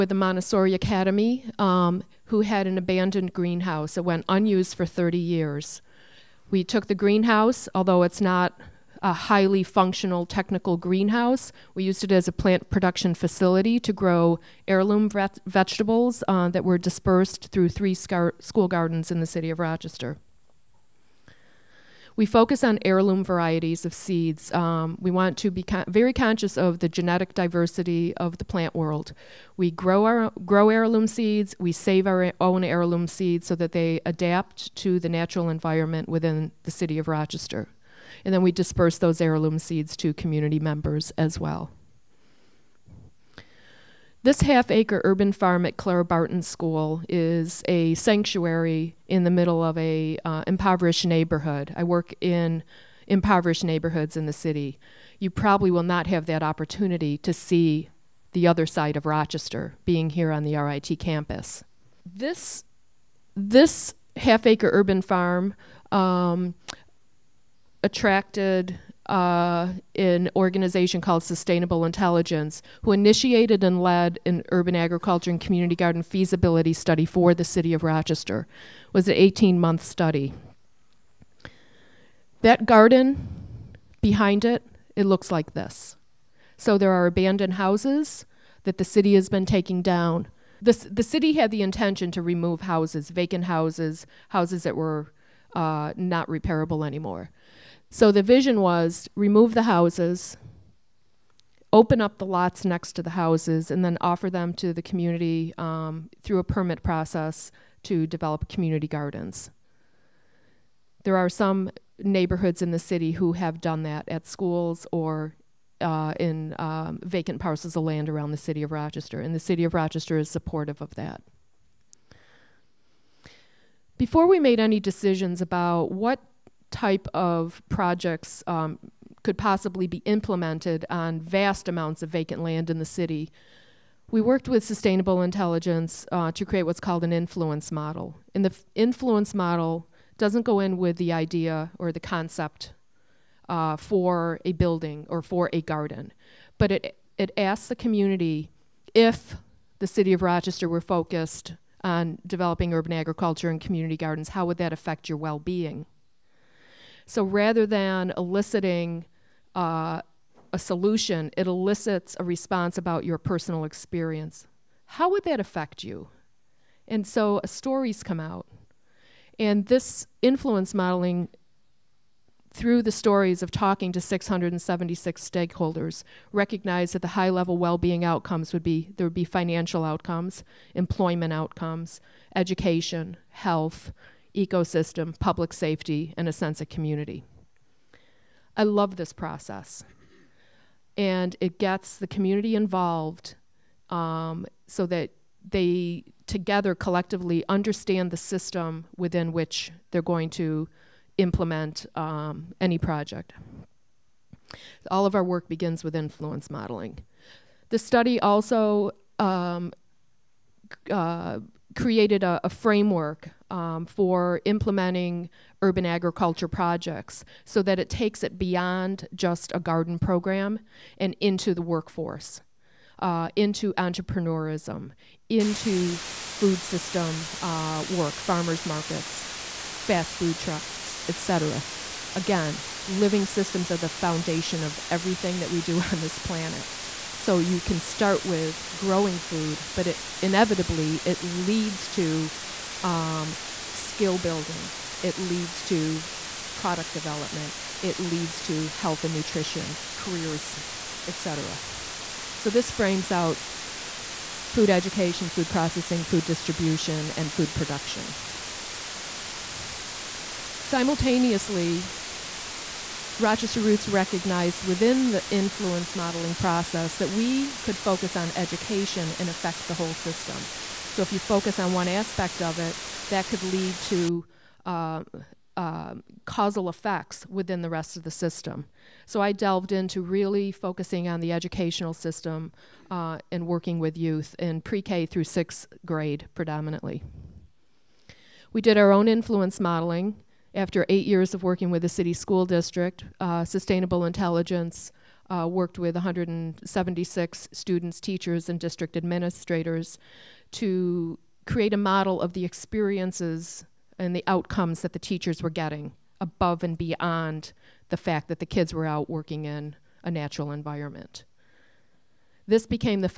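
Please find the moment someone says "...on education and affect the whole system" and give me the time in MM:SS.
04:28.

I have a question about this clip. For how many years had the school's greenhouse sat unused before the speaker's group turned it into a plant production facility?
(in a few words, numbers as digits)
30.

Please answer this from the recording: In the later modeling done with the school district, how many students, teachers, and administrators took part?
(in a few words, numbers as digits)
176.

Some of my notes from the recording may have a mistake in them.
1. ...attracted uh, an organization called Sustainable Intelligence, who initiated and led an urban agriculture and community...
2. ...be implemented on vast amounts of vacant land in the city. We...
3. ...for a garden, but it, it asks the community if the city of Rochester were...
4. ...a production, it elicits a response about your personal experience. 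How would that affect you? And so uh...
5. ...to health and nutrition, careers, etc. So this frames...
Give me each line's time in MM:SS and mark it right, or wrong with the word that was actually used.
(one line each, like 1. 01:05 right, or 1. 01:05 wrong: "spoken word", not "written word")
1. 01:07 right
2. 02:09 right
3. 02:25 right
4. 02:40 wrong: "solution", not "production"
5. 04:08 right.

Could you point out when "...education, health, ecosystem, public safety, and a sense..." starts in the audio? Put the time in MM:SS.
03:02.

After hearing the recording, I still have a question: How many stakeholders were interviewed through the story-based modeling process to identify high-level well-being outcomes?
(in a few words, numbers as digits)
676.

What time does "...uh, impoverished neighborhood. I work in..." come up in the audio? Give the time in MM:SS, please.
00:50.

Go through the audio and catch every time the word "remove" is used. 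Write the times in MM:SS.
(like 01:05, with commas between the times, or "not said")
01:32, 01:39.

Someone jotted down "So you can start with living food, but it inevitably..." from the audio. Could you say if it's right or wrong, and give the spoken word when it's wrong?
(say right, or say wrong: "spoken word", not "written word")
wrong: "growing", not "living".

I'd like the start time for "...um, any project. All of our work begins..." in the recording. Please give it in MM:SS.
03:21.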